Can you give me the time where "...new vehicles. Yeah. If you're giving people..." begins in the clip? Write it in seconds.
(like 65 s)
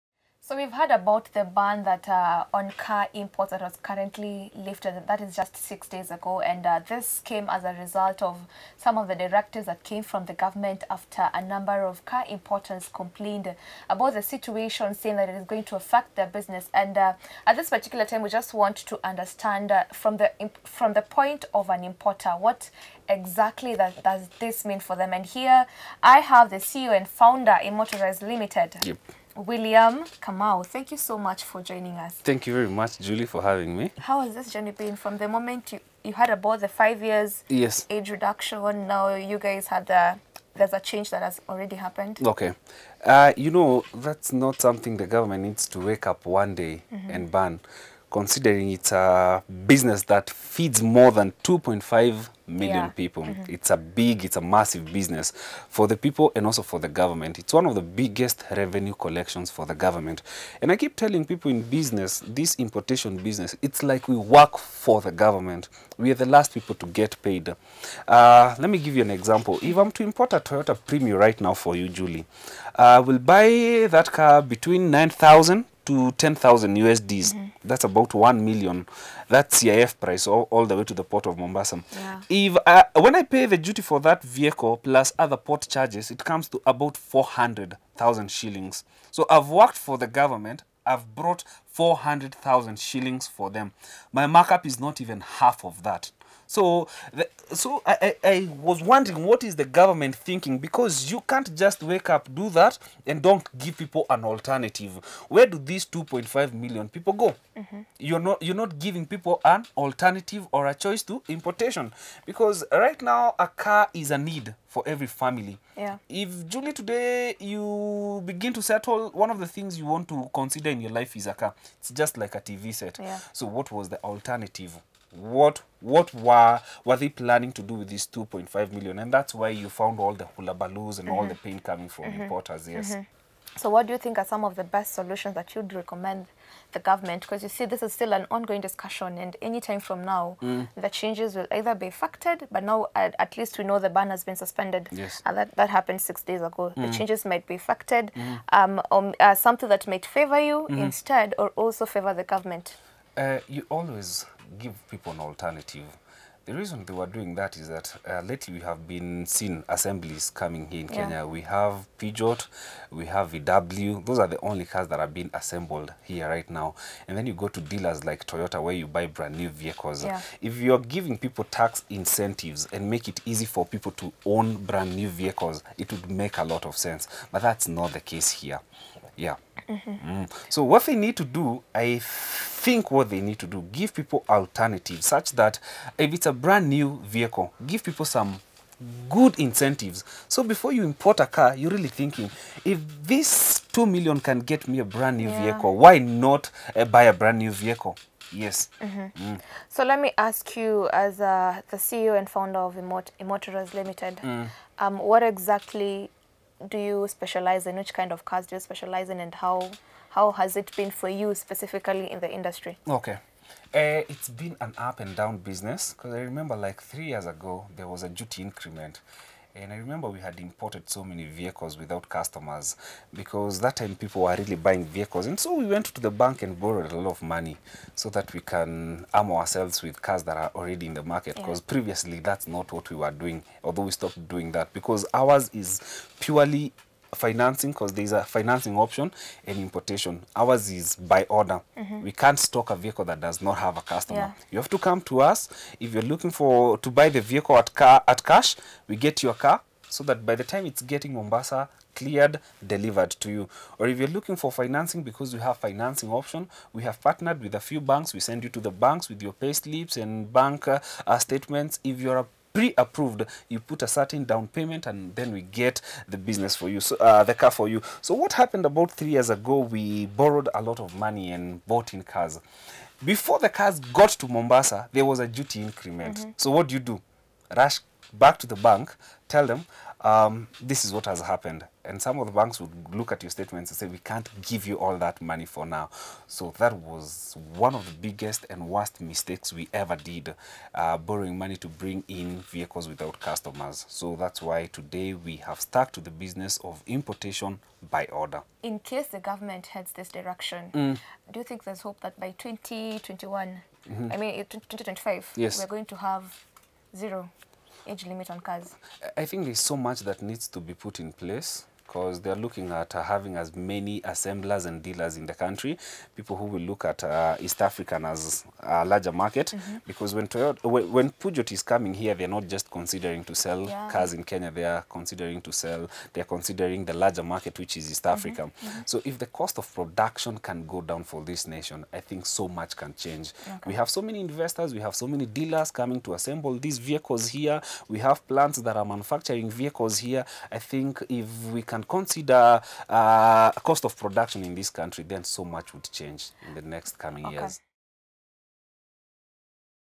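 169 s.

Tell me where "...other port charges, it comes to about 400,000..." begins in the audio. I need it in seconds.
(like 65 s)
85 s.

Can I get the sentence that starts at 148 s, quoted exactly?
um, or uh, something that might favor you mm-hmm.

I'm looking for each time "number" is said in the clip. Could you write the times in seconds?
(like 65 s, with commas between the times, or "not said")
11 s.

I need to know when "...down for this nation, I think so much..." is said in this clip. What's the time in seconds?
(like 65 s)
330 s.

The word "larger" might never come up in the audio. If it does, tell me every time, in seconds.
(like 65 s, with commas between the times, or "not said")
318 s, 326 s.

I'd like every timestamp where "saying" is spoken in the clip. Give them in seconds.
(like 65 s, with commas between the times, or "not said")
14 s.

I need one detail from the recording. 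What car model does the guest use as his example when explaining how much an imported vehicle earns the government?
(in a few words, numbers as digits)
Toyota Premio.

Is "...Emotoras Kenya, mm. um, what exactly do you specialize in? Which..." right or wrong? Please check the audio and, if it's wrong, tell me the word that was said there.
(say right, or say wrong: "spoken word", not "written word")
wrong: "Limited", not "Kenya".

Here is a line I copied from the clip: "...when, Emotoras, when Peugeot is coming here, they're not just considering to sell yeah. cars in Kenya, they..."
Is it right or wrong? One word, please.
wrong.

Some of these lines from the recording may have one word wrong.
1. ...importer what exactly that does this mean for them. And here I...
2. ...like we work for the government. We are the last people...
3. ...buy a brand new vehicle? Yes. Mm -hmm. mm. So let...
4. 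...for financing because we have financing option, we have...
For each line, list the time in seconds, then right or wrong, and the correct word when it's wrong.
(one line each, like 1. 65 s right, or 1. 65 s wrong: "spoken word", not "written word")
1. 21 s right
2. 63 s right
3. 196 s right
4. 254 s right.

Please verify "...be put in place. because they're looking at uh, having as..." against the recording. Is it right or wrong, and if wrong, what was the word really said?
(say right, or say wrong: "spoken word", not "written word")
right.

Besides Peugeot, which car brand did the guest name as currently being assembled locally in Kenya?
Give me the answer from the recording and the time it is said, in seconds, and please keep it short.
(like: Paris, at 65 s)
VW, at 163 s.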